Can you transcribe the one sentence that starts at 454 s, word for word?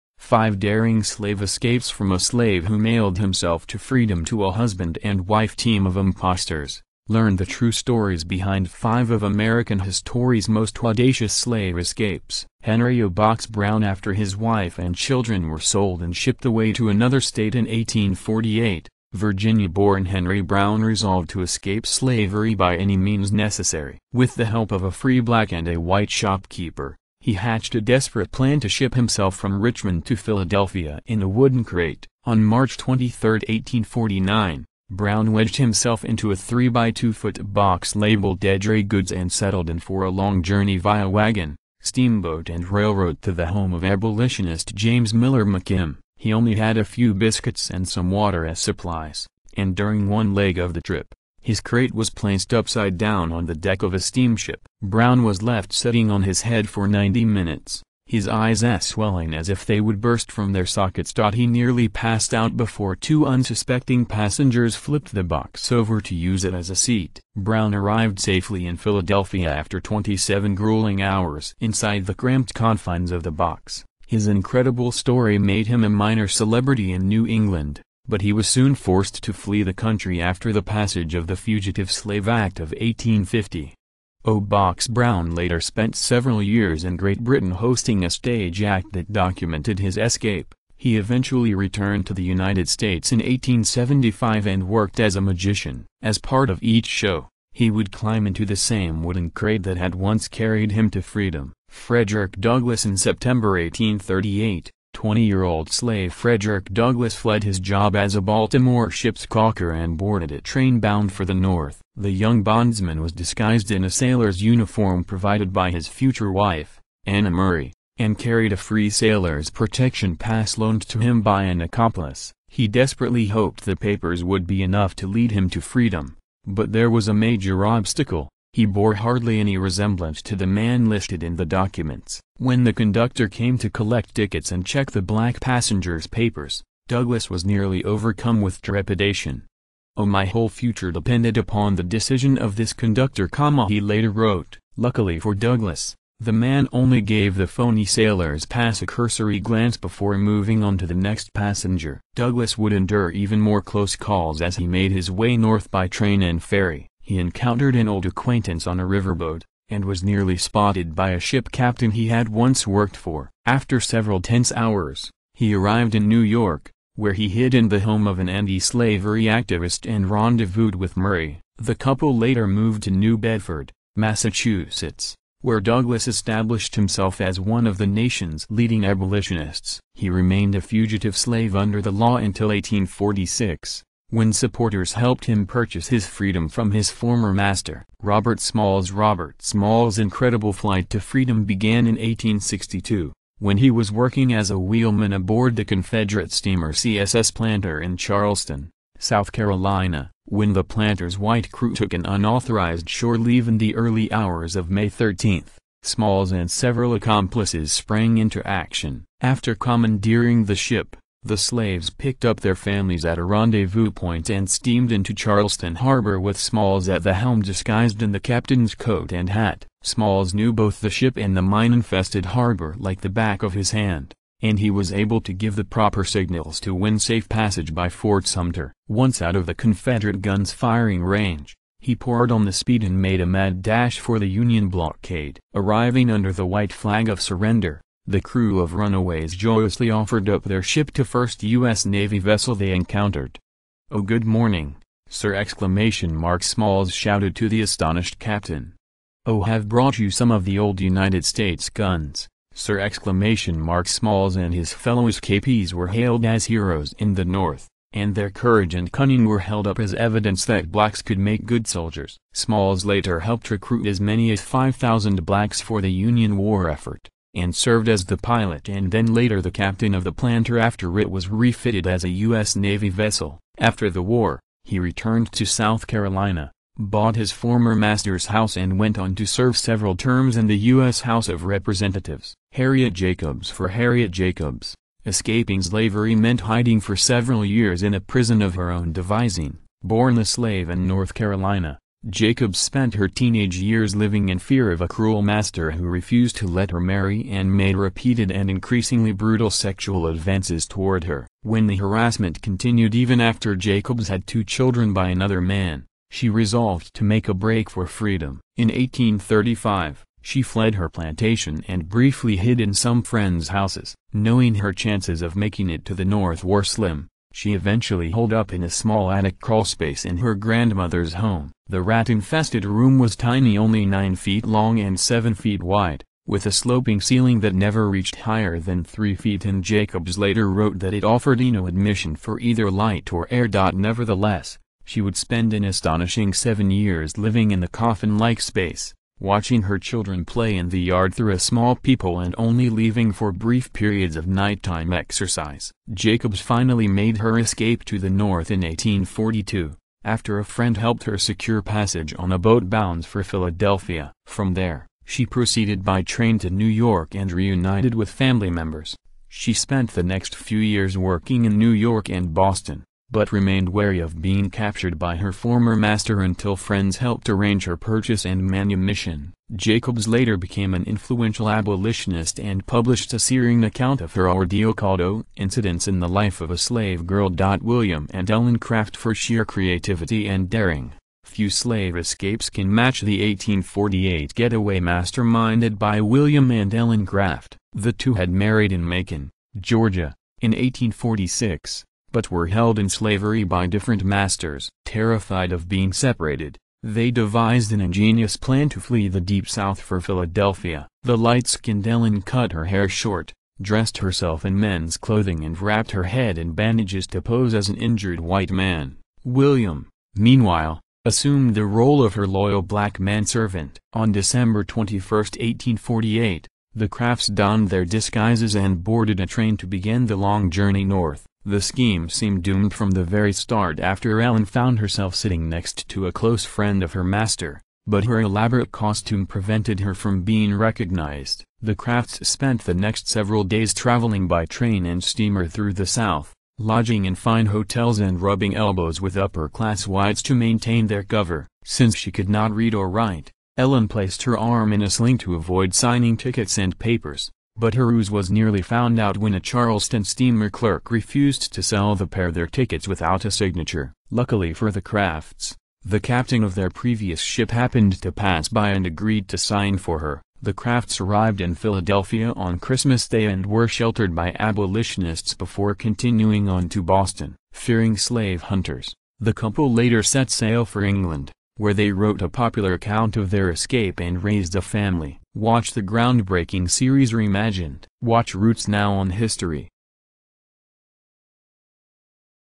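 Luckily for the Crafts, the captain of their previous ship happened to pass by and agreed to sign for her.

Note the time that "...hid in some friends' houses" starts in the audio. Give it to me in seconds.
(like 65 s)
312 s.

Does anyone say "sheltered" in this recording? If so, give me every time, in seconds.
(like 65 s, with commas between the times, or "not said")
463 s.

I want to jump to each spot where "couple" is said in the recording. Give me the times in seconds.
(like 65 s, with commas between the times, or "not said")
171 s, 469 s.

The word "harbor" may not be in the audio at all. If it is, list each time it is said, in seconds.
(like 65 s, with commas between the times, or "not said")
215 s, 222 s.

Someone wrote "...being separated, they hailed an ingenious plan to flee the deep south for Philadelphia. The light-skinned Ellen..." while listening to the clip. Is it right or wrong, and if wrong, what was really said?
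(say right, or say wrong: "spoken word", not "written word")
wrong: "devised", not "hailed".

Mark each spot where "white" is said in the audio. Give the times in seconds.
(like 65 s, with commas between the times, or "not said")
25 s, 201 s, 236 s, 408 s, 439 s.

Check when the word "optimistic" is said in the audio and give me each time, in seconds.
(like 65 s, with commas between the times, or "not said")
not said.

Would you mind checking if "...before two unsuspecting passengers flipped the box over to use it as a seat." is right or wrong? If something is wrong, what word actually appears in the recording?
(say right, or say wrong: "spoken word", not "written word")
right.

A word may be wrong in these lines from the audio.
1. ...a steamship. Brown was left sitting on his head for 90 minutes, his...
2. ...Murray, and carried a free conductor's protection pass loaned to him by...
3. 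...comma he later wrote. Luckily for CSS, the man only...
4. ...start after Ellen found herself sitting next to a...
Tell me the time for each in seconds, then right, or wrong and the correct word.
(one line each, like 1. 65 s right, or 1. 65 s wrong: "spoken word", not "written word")
1. 53 s right
2. 117 s wrong: "sailor", not "conductor"
3. 143 s wrong: "Douglass", not "CSS"
4. 423 s right.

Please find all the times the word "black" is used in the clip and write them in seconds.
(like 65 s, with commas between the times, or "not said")
25 s, 135 s, 260 s, 265 s, 412 s.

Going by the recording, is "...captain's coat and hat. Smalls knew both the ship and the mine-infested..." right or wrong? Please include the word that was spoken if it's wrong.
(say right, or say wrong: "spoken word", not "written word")
right.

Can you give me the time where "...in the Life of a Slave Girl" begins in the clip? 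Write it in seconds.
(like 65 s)
375 s.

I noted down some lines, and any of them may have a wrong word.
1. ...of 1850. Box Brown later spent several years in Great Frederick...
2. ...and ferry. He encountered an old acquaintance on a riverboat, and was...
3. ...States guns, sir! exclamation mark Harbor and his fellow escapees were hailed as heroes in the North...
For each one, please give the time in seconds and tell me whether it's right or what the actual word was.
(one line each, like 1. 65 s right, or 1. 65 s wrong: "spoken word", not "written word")
1. 82 s wrong: "Britain", not "Frederick"
2. 156 s right
3. 251 s wrong: "Smalls", not "Harbor".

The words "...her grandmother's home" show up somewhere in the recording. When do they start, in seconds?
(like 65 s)
320 s.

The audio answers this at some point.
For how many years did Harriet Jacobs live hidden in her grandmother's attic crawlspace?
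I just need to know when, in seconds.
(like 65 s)
336 s.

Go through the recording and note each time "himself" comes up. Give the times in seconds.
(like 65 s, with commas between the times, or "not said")
3 s, 28 s, 35 s, 176 s.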